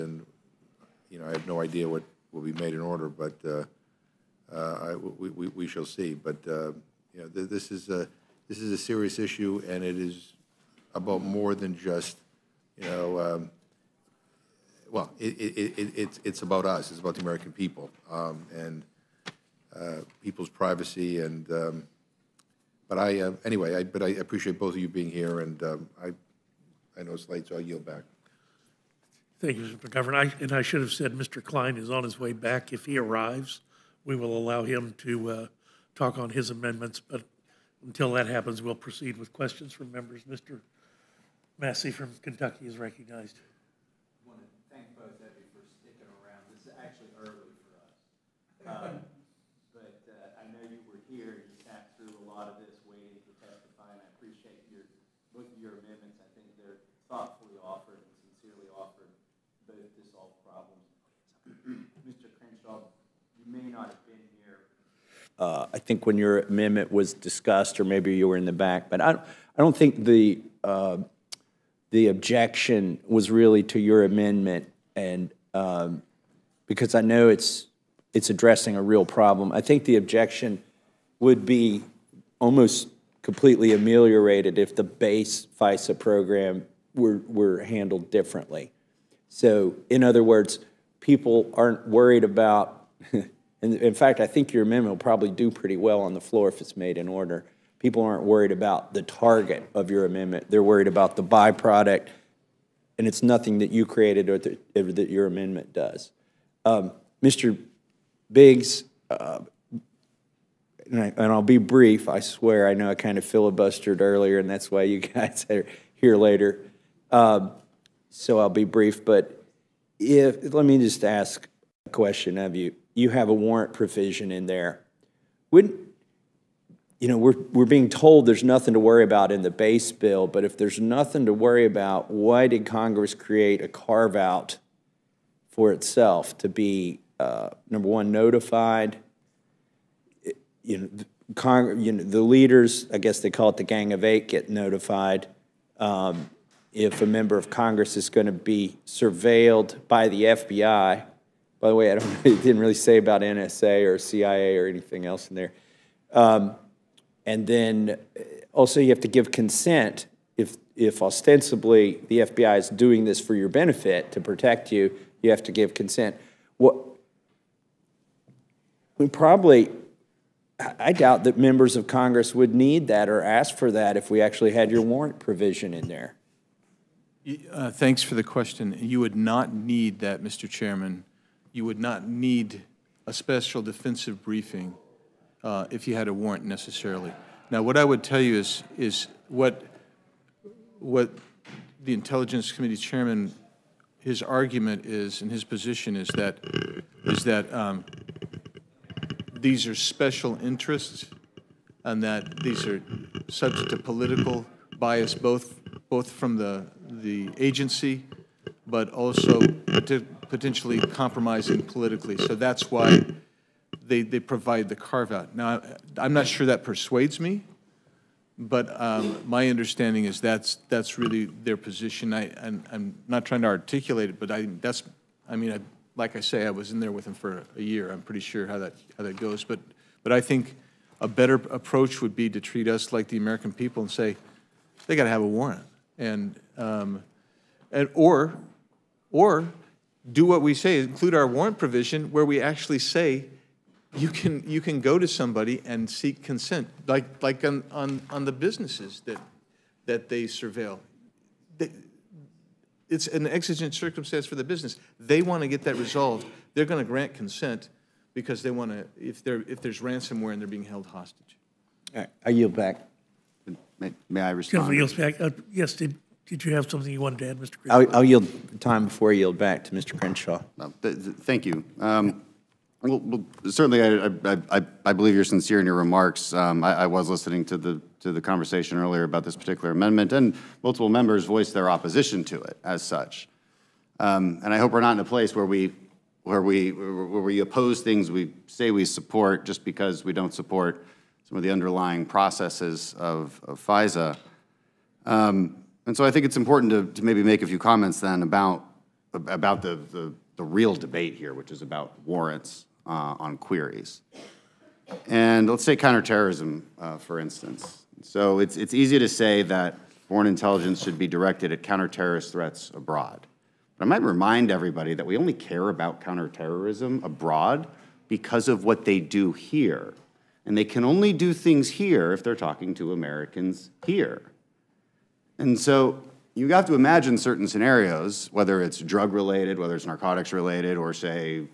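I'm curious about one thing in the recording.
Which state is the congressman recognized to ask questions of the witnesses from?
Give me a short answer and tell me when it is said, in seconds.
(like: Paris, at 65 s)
Kentucky, at 42 s.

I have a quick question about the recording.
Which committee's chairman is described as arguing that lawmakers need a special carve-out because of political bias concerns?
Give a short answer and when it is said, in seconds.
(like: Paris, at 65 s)
Intelligence Committee, at 191 s.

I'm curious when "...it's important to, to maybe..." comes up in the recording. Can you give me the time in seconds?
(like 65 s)
296 s.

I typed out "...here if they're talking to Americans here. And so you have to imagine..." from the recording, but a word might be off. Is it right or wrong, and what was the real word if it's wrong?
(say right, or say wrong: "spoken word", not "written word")
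right.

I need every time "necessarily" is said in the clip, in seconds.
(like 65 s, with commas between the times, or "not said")
186 s.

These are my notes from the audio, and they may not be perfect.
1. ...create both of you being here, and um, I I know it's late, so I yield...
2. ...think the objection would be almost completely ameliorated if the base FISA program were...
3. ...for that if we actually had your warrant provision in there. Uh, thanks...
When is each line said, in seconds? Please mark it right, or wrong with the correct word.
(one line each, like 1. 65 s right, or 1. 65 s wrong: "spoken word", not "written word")
1. 24 s wrong: "appreciate", not "create"
2. 79 s right
3. 173 s right.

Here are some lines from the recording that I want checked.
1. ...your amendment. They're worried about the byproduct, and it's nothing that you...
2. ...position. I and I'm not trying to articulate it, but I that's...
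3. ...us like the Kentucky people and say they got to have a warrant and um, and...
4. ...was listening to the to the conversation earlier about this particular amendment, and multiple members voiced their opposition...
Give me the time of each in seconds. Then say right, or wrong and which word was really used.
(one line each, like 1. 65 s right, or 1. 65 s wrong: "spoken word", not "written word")
1. 99 s right
2. 221 s right
3. 232 s wrong: "American", not "Kentucky"
4. 276 s right.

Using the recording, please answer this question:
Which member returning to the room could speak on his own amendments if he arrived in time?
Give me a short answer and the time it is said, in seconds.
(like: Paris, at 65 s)
Mr. Cline, at 31 s.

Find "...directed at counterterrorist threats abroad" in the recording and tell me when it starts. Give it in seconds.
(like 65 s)
311 s.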